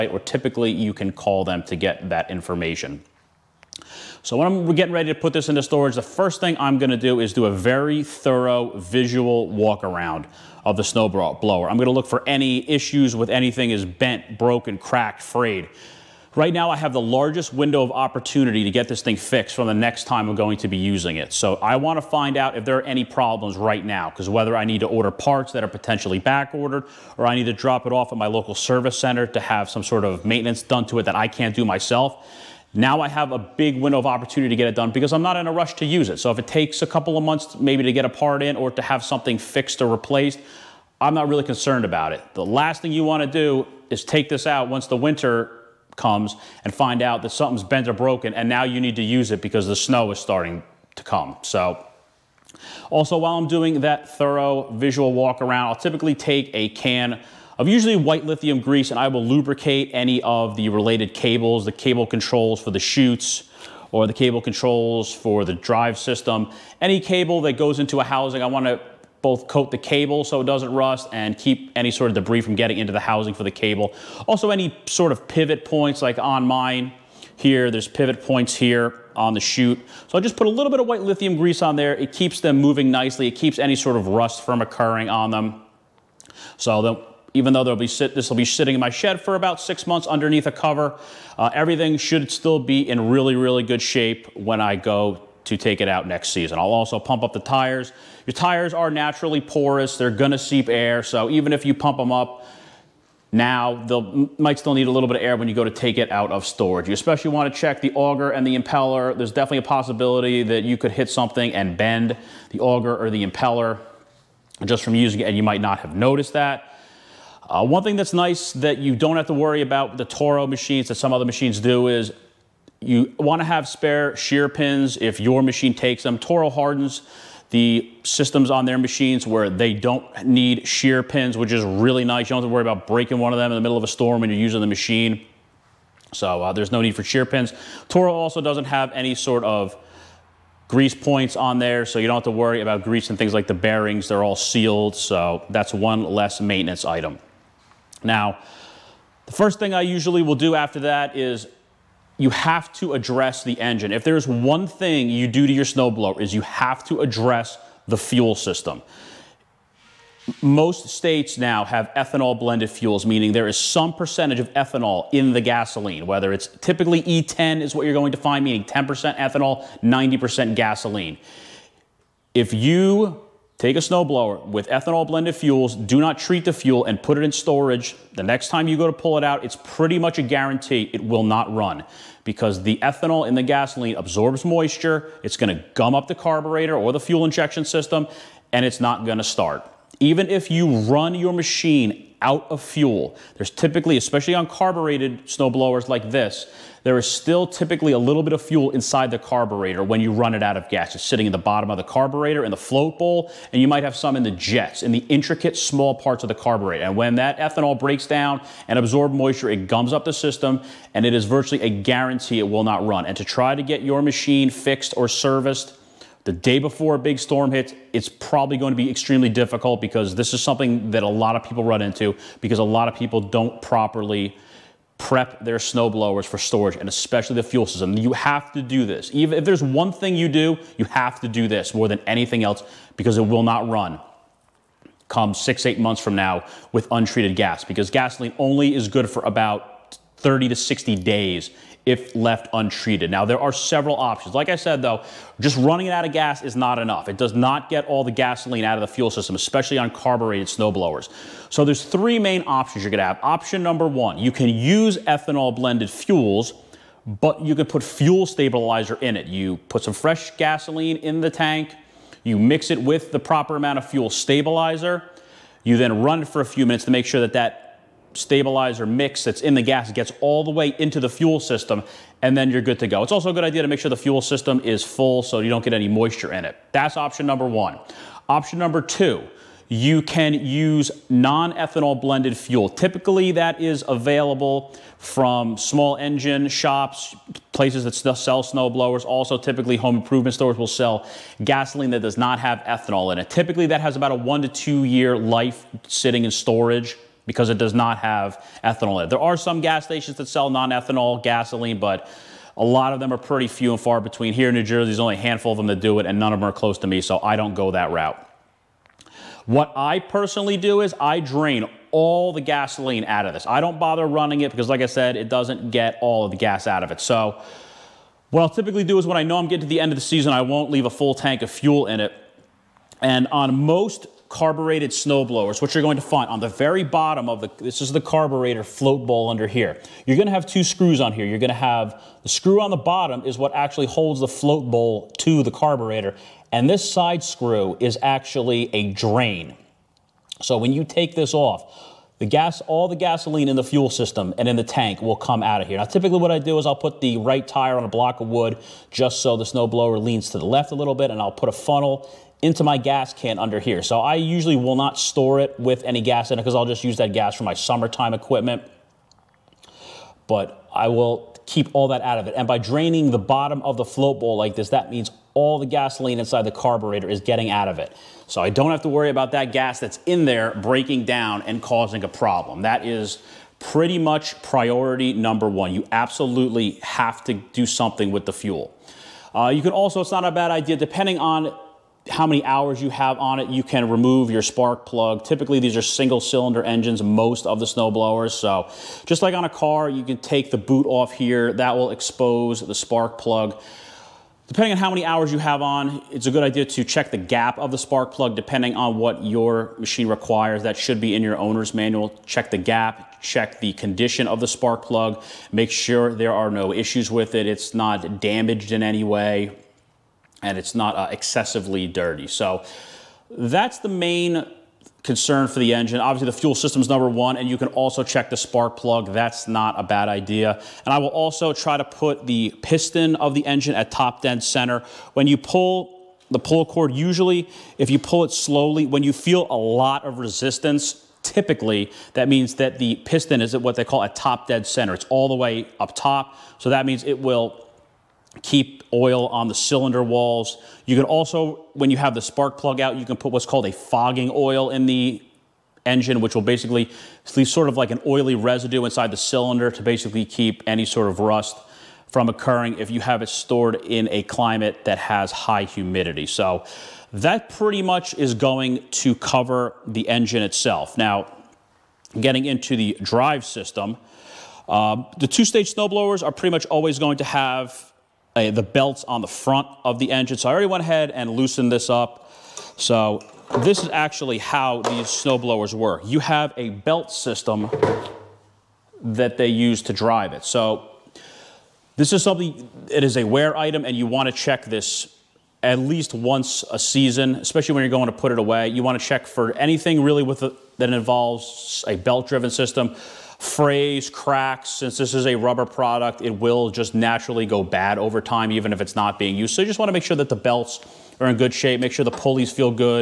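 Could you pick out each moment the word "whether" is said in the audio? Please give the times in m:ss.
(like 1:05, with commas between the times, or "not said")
0:24, 2:46.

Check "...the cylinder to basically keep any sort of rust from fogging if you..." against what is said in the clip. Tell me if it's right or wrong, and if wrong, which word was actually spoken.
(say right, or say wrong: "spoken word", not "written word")
wrong: "occurring", not "fogging".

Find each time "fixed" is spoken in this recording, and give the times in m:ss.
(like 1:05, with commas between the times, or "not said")
0:19, 0:39, 3:34.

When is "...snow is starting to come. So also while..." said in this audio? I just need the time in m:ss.
0:49.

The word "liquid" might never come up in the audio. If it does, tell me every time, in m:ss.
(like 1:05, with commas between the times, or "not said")
not said.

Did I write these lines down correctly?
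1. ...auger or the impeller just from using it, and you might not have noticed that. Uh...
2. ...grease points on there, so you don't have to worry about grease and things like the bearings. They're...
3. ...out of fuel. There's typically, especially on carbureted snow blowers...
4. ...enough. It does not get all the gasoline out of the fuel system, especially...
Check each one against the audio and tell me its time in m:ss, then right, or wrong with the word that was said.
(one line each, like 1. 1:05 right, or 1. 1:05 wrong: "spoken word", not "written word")
1. 1:52 right
2. 2:20 right
3. 3:12 right
4. 4:06 right.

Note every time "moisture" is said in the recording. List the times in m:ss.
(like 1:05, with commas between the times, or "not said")
3:04, 3:29, 4:35.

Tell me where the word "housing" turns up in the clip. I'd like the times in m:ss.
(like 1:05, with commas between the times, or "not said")
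1:08, 1:12.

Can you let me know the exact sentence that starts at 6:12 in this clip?
That is pretty much priority number one.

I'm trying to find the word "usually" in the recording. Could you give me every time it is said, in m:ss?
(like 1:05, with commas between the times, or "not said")
0:57, 2:29, 5:54, 7:06.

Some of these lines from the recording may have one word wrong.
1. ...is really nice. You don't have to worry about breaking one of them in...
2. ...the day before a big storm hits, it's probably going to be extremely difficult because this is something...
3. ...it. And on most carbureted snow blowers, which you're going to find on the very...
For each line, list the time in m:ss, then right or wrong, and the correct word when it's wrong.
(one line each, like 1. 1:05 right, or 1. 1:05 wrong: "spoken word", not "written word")
1. 2:11 right
2. 3:36 right
3. 5:21 right.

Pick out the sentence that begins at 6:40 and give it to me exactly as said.
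That should be in your owner's manual.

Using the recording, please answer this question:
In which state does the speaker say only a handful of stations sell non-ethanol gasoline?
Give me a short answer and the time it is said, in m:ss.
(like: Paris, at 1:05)
New Jersey, at 5:04.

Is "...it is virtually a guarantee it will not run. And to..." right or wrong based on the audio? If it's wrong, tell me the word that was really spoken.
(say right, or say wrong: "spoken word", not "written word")
right.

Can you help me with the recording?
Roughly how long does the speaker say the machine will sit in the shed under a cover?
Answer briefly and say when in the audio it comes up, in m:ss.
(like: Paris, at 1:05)
6 months, at 1:29.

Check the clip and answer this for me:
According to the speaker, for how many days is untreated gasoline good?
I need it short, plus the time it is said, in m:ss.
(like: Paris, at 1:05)
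30 to 60 days, at 4:00.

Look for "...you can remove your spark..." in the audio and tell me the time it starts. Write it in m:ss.
6:23.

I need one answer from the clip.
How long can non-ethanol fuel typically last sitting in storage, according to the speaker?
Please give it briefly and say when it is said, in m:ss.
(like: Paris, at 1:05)
1 to 2 years, at 4:54.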